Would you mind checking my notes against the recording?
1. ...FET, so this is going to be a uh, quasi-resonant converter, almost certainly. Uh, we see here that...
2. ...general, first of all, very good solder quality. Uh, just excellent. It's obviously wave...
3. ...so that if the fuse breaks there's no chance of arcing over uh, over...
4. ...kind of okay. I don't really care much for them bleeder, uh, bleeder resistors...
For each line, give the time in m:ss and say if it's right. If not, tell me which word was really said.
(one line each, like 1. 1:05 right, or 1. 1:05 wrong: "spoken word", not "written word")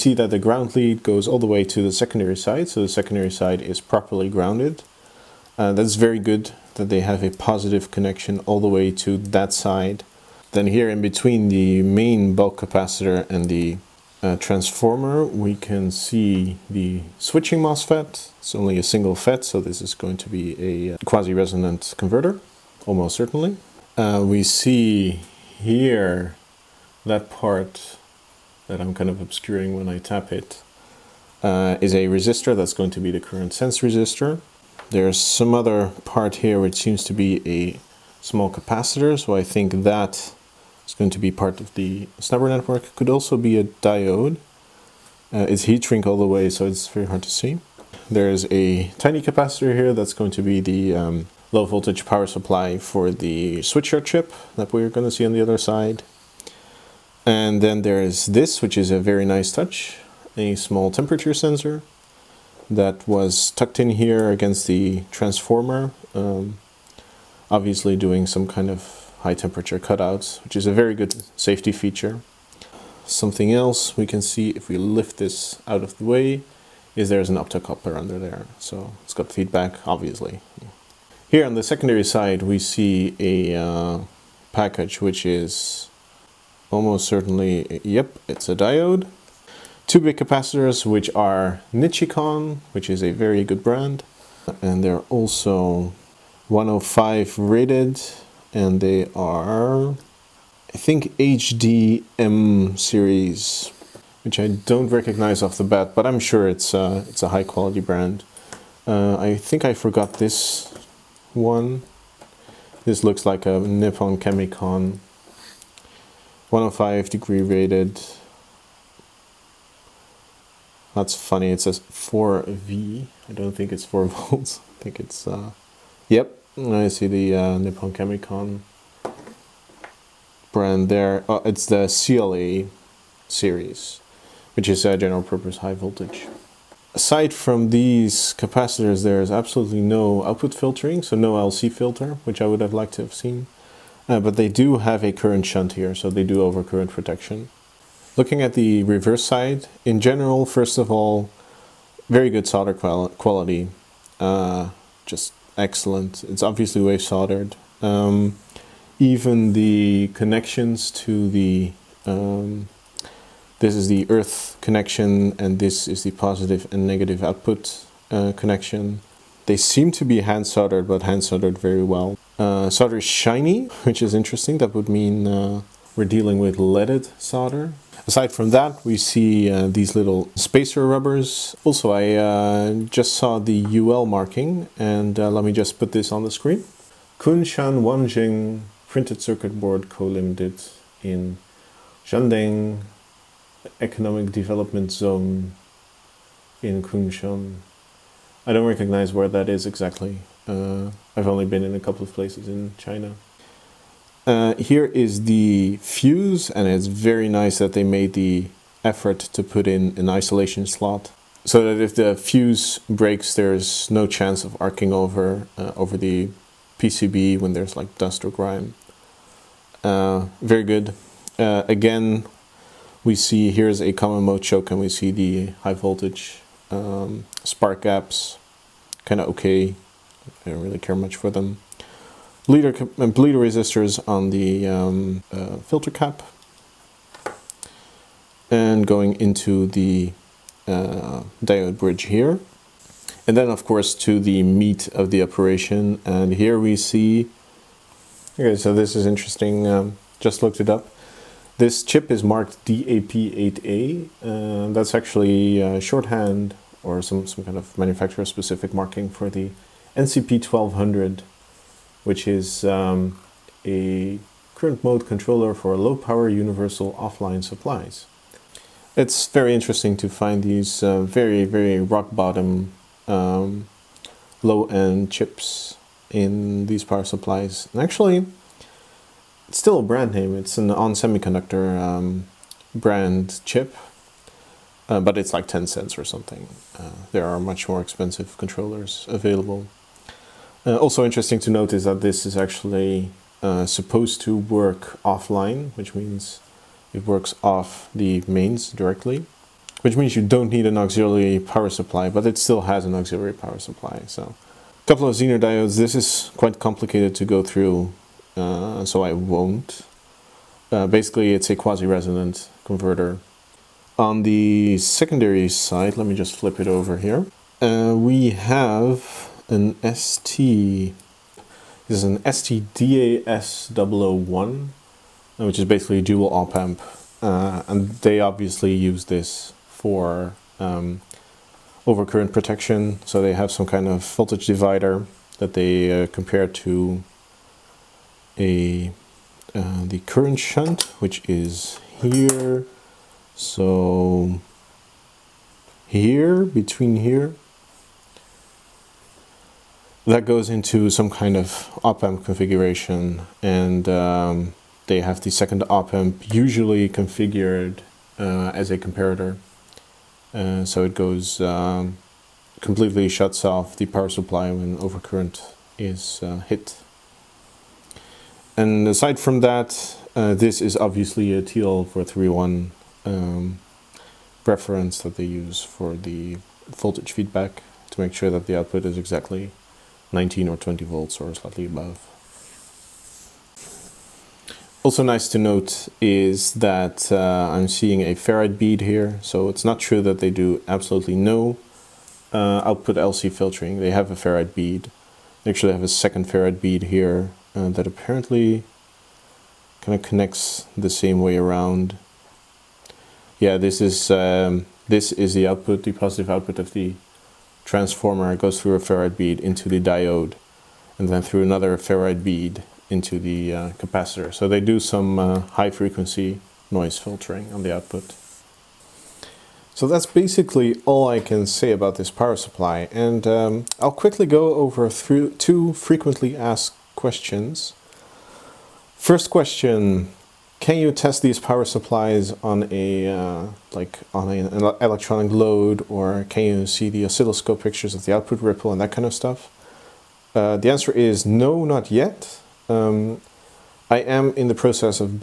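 1. 0:19 right
2. 2:29 right
3. 3:31 right
4. 3:49 right.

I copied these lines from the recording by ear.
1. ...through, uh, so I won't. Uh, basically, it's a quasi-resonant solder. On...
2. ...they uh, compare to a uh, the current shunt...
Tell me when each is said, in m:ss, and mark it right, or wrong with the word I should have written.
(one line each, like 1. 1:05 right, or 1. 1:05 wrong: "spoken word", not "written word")
1. 5:07 wrong: "converter", not "solder"
2. 5:35 right.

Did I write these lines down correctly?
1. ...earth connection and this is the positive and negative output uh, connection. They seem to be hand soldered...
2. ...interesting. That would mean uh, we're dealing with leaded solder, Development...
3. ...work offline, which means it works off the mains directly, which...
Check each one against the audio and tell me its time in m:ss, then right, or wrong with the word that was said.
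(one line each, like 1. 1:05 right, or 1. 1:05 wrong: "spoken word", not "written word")
1. 2:44 right
2. 2:54 wrong: "Aside", not "Development"
3. 4:54 right.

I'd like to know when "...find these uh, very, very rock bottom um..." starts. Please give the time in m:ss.
4:30.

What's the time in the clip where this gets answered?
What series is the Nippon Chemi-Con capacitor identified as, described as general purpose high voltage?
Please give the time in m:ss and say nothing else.
2:11.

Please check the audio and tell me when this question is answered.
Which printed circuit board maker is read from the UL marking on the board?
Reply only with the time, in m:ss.
3:07.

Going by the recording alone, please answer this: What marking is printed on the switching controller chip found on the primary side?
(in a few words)
DAP8A.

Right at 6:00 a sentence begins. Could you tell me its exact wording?
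Uh, so it goes um, completely shuts off the power supply when overcurrent is uh, hit.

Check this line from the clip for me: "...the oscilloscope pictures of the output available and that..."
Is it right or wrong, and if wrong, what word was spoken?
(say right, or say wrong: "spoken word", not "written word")
wrong: "ripple", not "available".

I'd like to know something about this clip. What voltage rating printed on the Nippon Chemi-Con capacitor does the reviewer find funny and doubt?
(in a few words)
4V.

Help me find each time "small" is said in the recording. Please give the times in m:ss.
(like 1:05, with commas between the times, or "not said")
0:38, 1:00.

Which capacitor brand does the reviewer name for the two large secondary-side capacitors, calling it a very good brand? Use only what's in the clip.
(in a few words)
Nichicon.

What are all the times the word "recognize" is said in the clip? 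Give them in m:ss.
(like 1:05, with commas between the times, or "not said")
1:44, 3:18.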